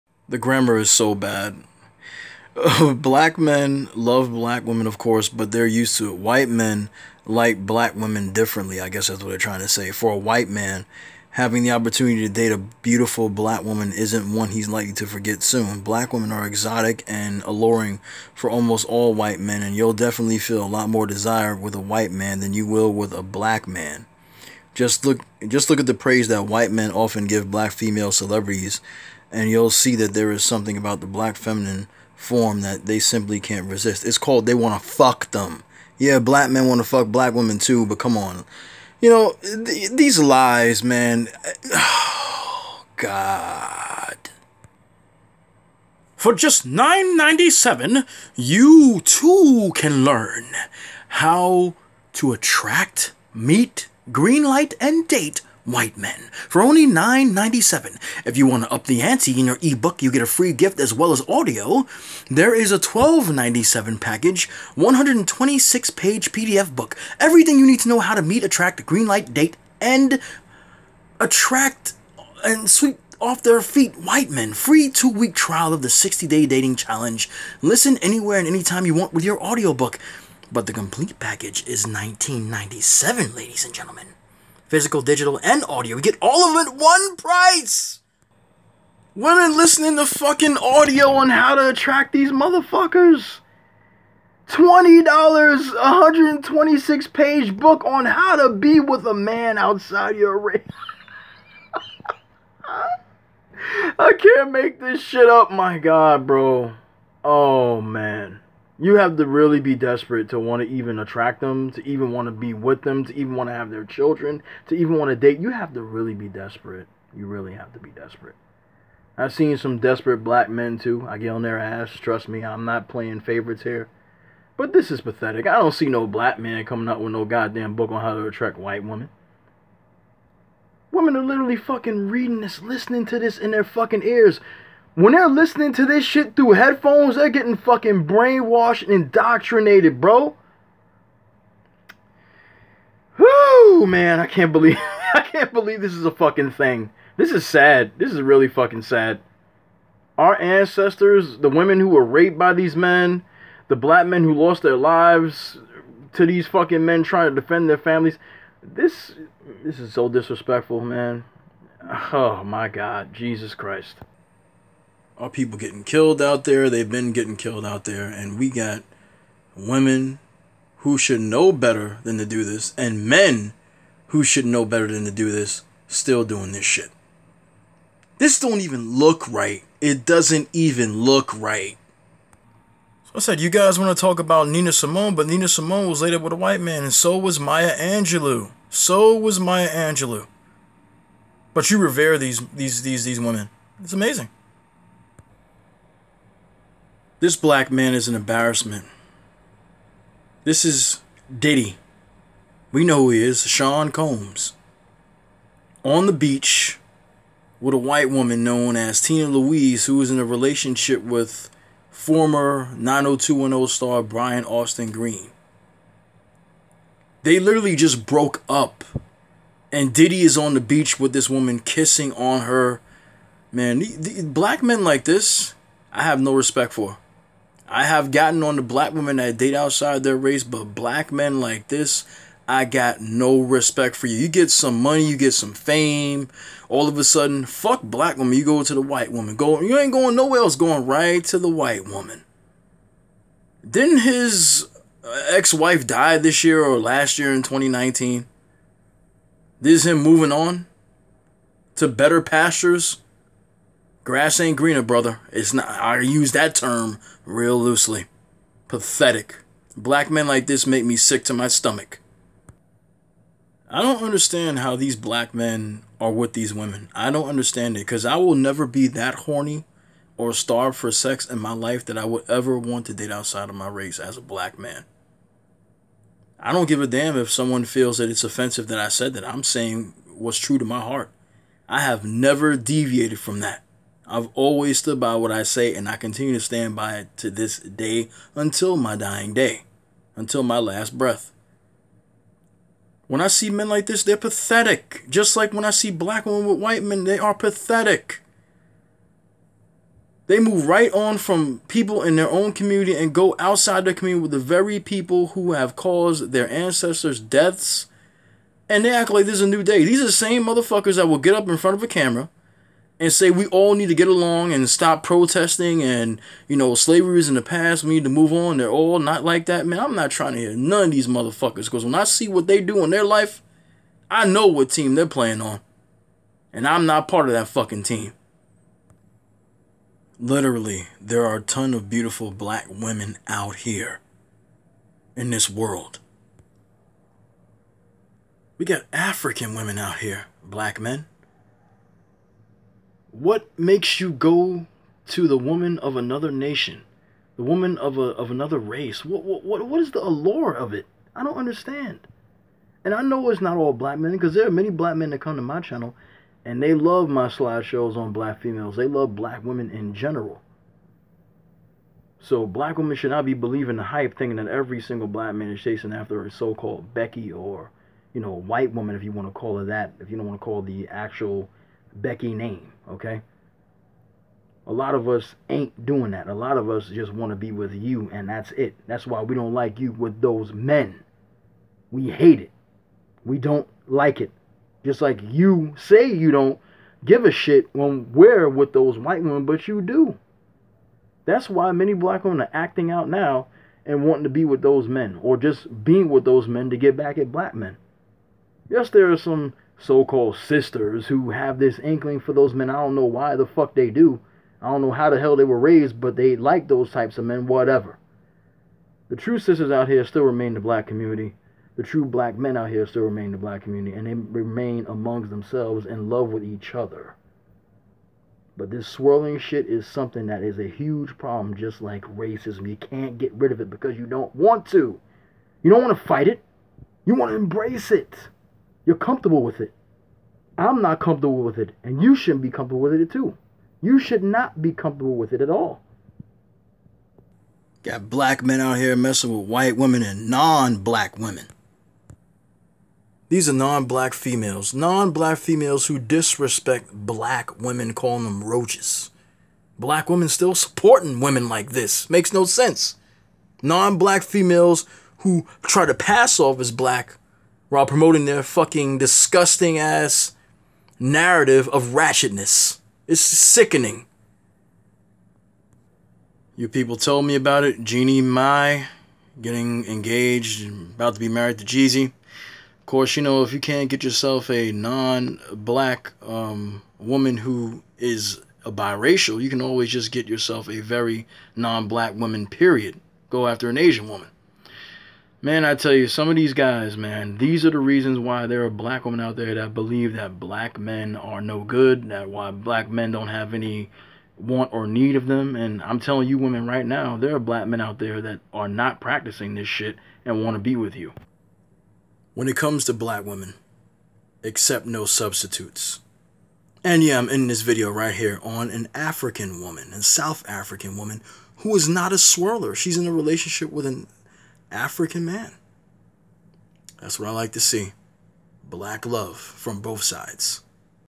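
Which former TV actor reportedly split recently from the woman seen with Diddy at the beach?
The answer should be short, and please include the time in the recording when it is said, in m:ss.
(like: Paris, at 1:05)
Brian Austin Green, at 3:34.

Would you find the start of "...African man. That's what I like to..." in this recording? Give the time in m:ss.
8:34.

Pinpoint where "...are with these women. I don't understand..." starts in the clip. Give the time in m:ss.
4:26.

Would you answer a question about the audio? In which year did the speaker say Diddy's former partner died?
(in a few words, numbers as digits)
2019.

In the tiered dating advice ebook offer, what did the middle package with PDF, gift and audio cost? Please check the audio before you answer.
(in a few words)
$12.97.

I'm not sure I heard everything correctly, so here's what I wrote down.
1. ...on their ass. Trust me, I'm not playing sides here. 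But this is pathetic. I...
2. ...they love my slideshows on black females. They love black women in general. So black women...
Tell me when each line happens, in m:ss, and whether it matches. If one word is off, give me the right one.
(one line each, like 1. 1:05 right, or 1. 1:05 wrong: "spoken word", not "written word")
1. 2:01 wrong: "favorites", not "sides"
2. 5:56 right.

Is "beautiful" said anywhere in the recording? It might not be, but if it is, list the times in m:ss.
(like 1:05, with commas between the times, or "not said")
0:12, 5:31.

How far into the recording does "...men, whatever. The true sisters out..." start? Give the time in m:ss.
6:47.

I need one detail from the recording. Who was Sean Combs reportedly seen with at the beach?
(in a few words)
Tina Louise.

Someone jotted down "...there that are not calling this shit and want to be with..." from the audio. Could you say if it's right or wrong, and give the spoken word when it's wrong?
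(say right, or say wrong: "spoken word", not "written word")
wrong: "practicing", not "calling".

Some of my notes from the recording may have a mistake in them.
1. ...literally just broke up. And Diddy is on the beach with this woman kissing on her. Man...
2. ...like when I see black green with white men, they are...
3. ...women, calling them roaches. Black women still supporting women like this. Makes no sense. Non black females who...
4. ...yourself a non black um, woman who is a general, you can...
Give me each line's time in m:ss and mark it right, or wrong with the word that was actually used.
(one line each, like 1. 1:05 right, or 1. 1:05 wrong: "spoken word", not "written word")
1. 3:37 right
2. 4:55 wrong: "women", not "green"
3. 7:27 right
4. 7:54 wrong: "biracial", not "general".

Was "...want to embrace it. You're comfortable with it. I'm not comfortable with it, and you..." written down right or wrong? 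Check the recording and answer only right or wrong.
right.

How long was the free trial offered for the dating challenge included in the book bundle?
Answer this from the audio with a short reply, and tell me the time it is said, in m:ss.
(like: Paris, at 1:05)
two week, at 1:14.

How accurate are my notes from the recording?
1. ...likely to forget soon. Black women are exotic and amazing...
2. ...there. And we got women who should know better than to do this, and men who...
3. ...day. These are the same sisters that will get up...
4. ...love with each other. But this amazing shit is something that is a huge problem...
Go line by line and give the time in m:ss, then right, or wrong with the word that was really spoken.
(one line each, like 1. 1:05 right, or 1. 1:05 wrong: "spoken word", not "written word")
1. 0:14 wrong: "alluring", not "amazing"
2. 2:47 right
3. 5:09 wrong: "motherfuckers", not "sisters"
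4. 6:56 wrong: "swirling", not "amazing".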